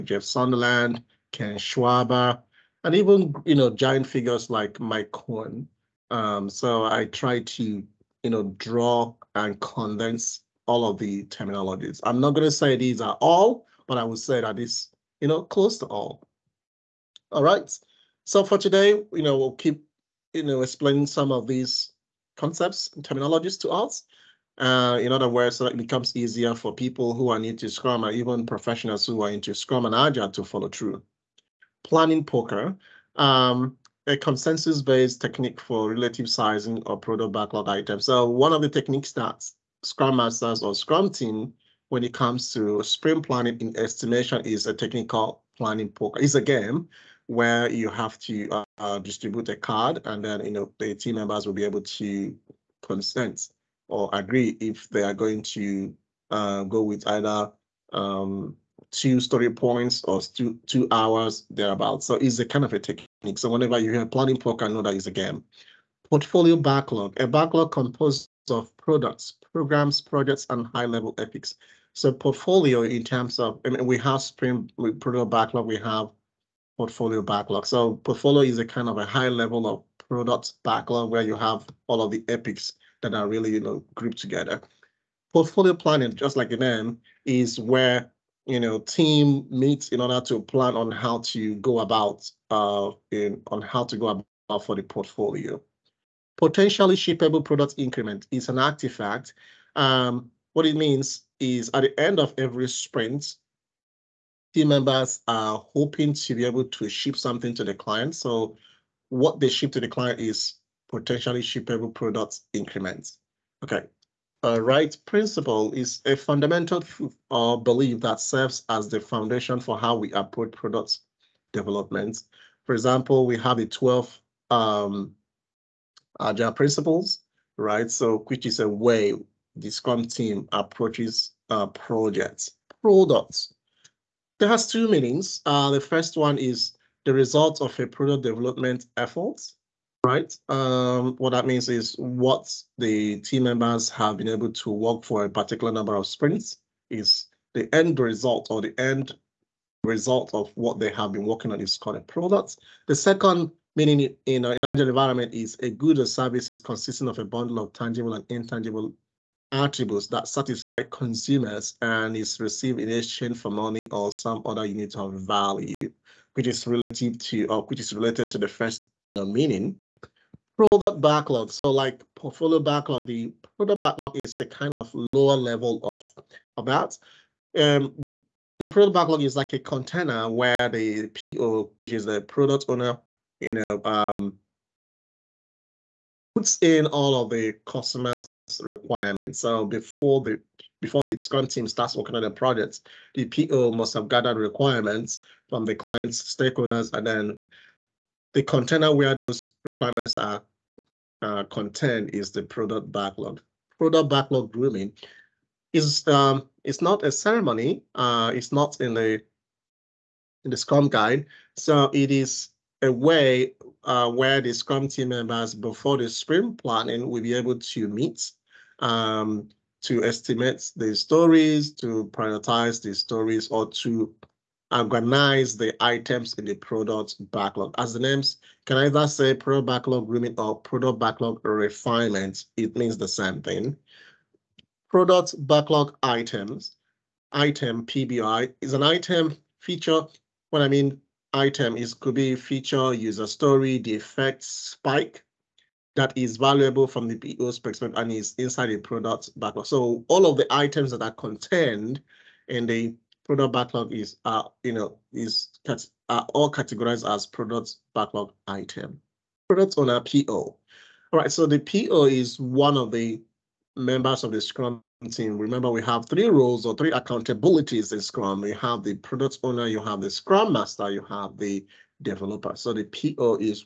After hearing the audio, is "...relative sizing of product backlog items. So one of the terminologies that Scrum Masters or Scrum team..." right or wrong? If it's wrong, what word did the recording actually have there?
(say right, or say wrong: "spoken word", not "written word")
wrong: "techniques", not "terminologies".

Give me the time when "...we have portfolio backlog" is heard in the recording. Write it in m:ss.
1:15.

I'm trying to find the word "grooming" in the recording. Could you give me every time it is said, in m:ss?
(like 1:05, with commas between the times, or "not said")
3:24, 3:50.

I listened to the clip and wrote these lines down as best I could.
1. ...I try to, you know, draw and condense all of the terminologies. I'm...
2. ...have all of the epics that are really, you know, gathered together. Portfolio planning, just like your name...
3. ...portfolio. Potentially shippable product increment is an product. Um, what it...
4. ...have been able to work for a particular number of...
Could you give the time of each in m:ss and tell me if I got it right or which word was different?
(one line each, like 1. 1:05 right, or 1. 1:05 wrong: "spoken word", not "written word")
1. 0:06 right
2. 1:21 wrong: "grouped", not "gathered"
3. 1:34 wrong: "artifact", not "product"
4. 2:23 right.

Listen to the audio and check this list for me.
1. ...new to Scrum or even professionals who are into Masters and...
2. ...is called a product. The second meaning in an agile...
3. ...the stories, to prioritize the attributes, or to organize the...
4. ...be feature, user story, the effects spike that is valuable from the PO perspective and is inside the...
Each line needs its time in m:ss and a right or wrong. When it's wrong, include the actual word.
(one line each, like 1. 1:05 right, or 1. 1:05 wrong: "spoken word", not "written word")
1. 0:27 wrong: "Scrum", not "Masters"
2. 2:31 right
3. 3:40 wrong: "stories", not "attributes"
4. 4:02 right.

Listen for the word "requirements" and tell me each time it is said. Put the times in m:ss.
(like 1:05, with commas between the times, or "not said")
3:08, 3:14, 3:19.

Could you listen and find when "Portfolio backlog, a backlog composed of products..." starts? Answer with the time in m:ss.
1:06.